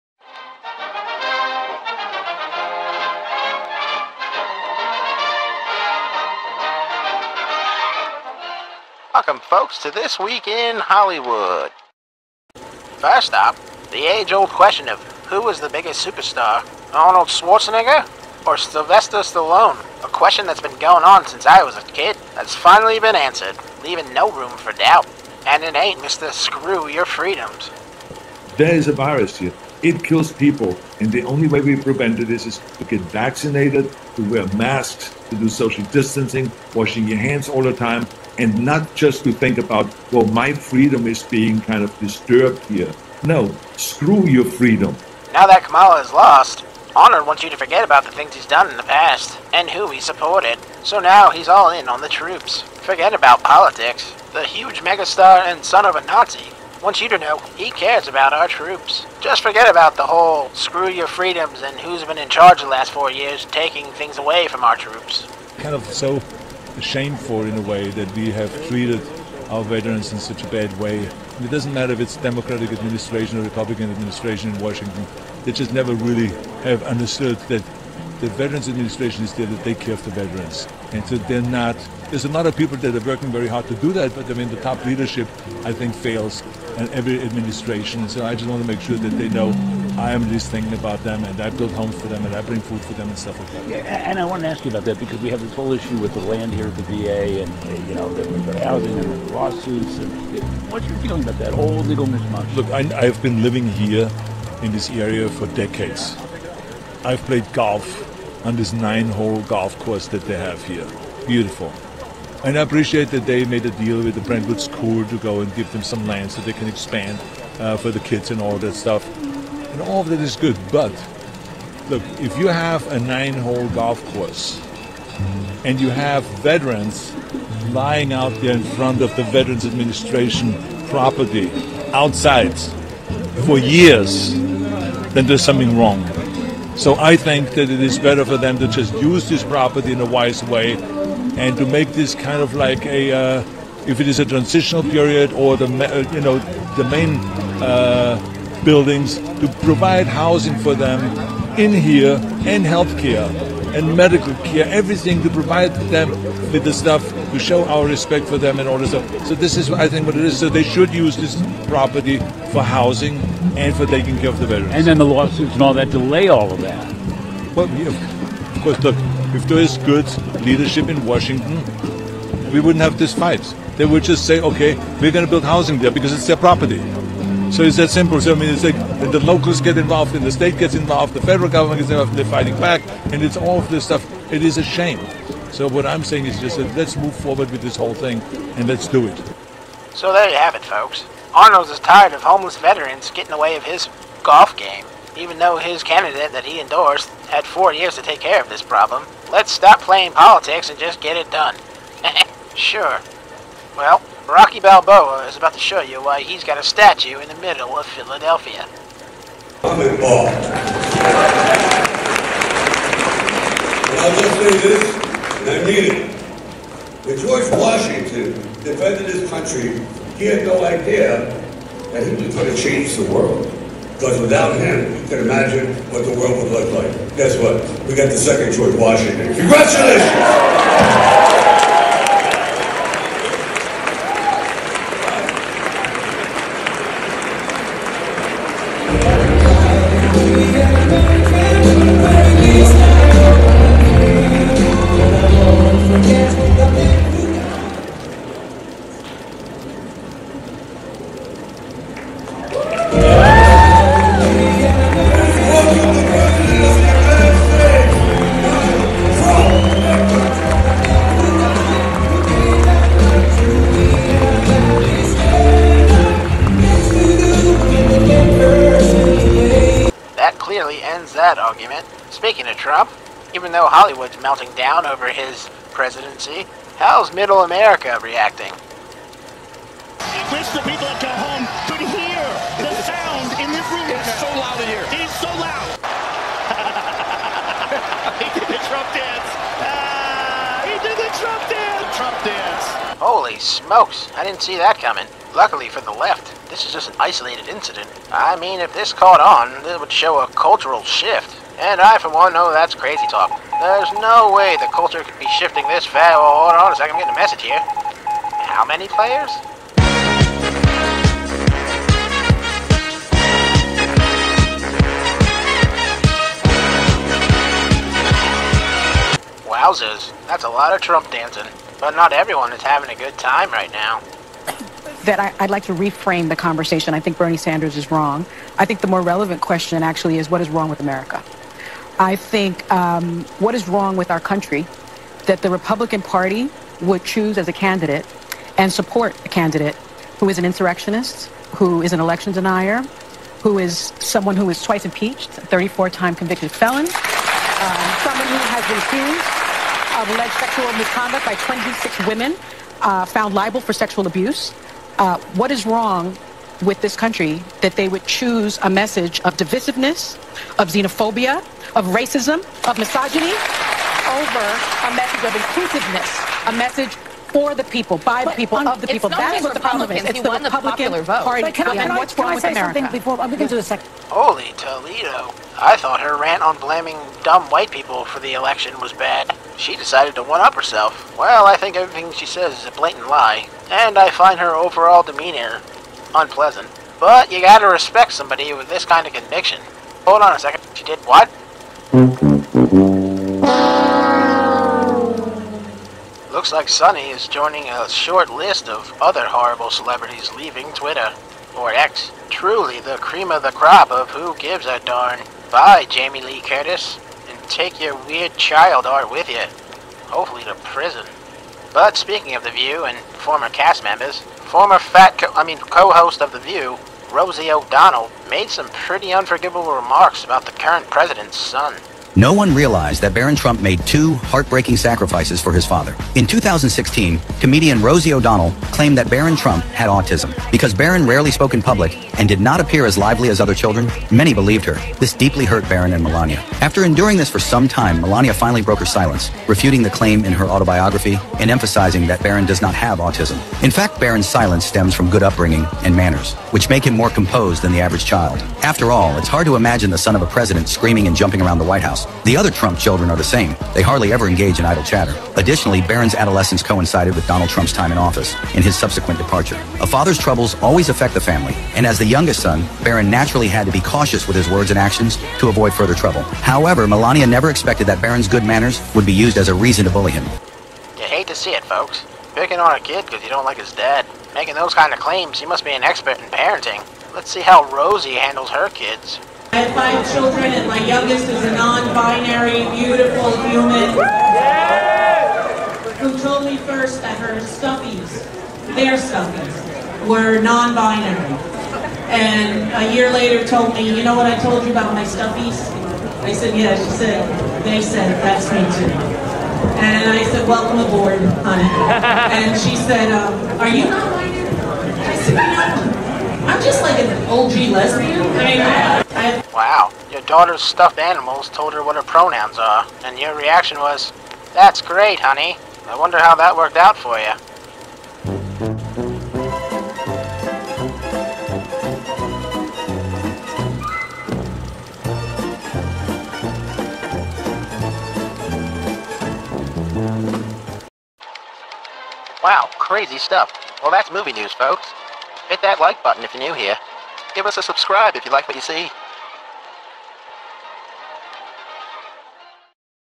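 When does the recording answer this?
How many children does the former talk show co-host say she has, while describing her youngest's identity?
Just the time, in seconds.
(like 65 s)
479 s.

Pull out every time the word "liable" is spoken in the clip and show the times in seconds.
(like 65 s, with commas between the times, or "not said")
353 s.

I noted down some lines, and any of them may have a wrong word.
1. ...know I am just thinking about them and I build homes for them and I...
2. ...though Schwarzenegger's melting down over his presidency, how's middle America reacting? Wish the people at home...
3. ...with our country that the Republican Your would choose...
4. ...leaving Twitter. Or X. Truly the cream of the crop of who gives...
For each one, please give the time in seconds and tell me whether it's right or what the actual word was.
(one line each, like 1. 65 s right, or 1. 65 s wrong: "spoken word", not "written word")
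1. 89 s right
2. 273 s wrong: "Hollywood", not "Schwarzenegger"
3. 333 s wrong: "Party", not "Your"
4. 400 s right.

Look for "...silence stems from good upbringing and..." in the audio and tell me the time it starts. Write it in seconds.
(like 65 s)
444 s.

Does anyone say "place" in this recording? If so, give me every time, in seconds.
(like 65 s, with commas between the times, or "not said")
not said.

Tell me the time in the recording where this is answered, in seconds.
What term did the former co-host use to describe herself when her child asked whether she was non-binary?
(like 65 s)
507 s.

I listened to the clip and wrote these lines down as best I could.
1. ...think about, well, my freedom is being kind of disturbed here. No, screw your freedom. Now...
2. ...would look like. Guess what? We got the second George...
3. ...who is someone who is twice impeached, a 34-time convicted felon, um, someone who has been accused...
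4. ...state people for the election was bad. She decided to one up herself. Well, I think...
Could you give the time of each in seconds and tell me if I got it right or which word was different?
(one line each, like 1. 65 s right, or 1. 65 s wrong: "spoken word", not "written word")
1. 39 s right
2. 226 s right
3. 343 s right
4. 377 s wrong: "white", not "state".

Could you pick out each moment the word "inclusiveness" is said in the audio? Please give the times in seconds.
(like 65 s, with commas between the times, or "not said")
365 s.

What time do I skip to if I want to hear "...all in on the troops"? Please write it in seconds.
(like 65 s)
51 s.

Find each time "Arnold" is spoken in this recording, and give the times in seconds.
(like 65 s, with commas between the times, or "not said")
16 s, 191 s.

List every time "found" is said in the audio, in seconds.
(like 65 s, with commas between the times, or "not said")
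353 s.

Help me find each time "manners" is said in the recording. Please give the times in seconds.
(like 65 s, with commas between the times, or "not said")
445 s, 468 s.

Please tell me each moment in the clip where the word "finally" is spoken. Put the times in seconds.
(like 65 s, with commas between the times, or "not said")
22 s, 438 s.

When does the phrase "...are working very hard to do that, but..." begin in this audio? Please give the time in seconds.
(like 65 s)
82 s.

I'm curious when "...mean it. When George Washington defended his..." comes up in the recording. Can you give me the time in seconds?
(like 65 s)
215 s.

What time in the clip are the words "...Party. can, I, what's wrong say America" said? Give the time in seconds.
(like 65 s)
371 s.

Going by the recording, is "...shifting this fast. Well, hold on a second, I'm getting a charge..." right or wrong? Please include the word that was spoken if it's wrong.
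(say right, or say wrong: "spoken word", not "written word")
wrong: "message", not "charge".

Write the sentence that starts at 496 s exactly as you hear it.
I said, yeah, she said, they said, that's me too.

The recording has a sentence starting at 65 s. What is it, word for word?
Kind of so shameful in a way that we have treated our veterans in such a bad way.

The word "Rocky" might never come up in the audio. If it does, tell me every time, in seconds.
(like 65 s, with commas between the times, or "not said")
204 s.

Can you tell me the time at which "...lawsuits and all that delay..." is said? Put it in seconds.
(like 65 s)
165 s.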